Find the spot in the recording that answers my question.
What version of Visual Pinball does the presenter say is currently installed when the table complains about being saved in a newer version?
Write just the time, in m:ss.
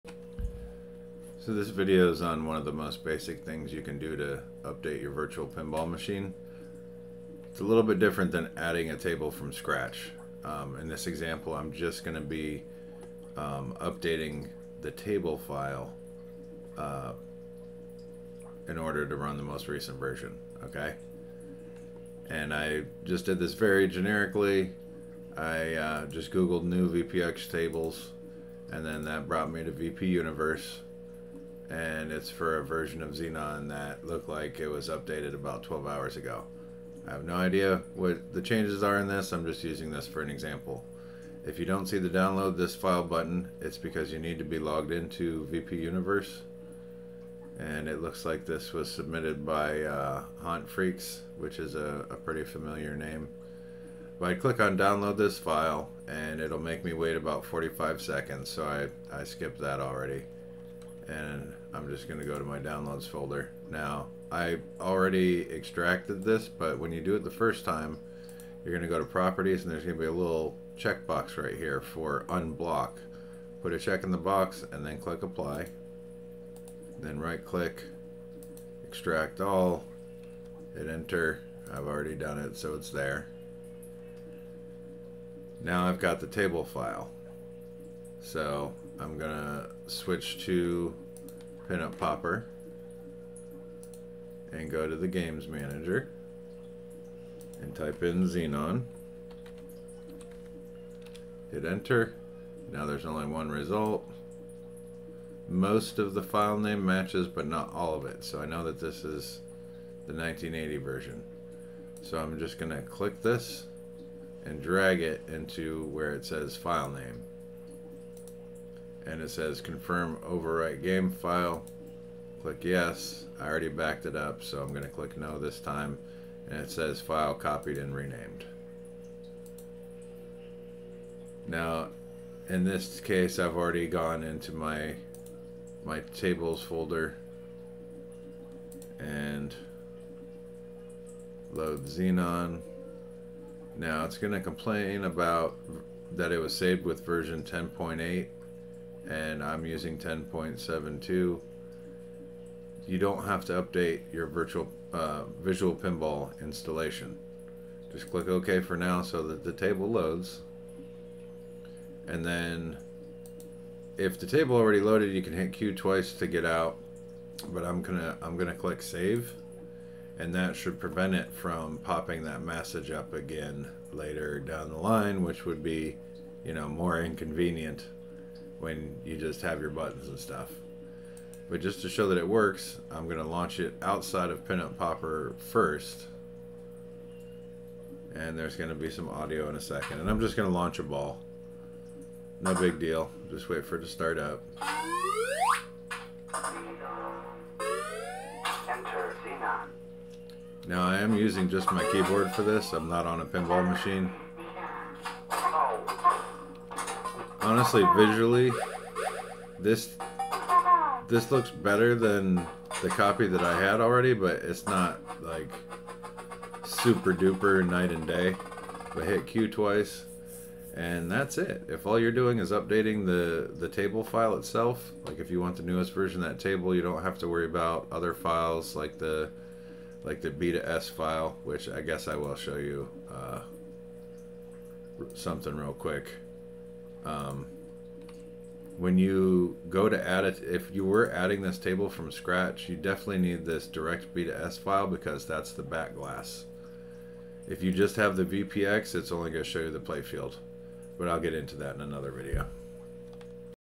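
2:29.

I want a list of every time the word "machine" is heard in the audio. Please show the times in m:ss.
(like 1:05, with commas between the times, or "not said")
0:05, 3:23.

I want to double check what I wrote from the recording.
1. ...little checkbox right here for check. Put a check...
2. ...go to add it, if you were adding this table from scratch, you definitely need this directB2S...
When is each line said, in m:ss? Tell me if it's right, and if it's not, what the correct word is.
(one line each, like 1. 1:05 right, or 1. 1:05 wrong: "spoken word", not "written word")
1. 1:10 wrong: "unblock", not "check"
2. 3:59 right.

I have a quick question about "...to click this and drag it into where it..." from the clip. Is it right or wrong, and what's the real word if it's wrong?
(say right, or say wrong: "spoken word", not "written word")
right.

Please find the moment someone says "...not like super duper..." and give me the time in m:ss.
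3:34.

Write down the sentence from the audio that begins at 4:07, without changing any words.
If you just have the VPX, it's only going to show you the playfield.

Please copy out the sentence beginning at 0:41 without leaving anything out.
If you don't see the download this file button, it's because you need to be logged into VP Universe.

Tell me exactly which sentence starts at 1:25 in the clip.
Now I've got the table file.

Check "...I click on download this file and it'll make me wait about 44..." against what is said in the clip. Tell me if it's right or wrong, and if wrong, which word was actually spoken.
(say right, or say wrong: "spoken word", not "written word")
wrong: "45", not "44".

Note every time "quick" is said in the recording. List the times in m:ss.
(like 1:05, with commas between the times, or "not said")
3:55.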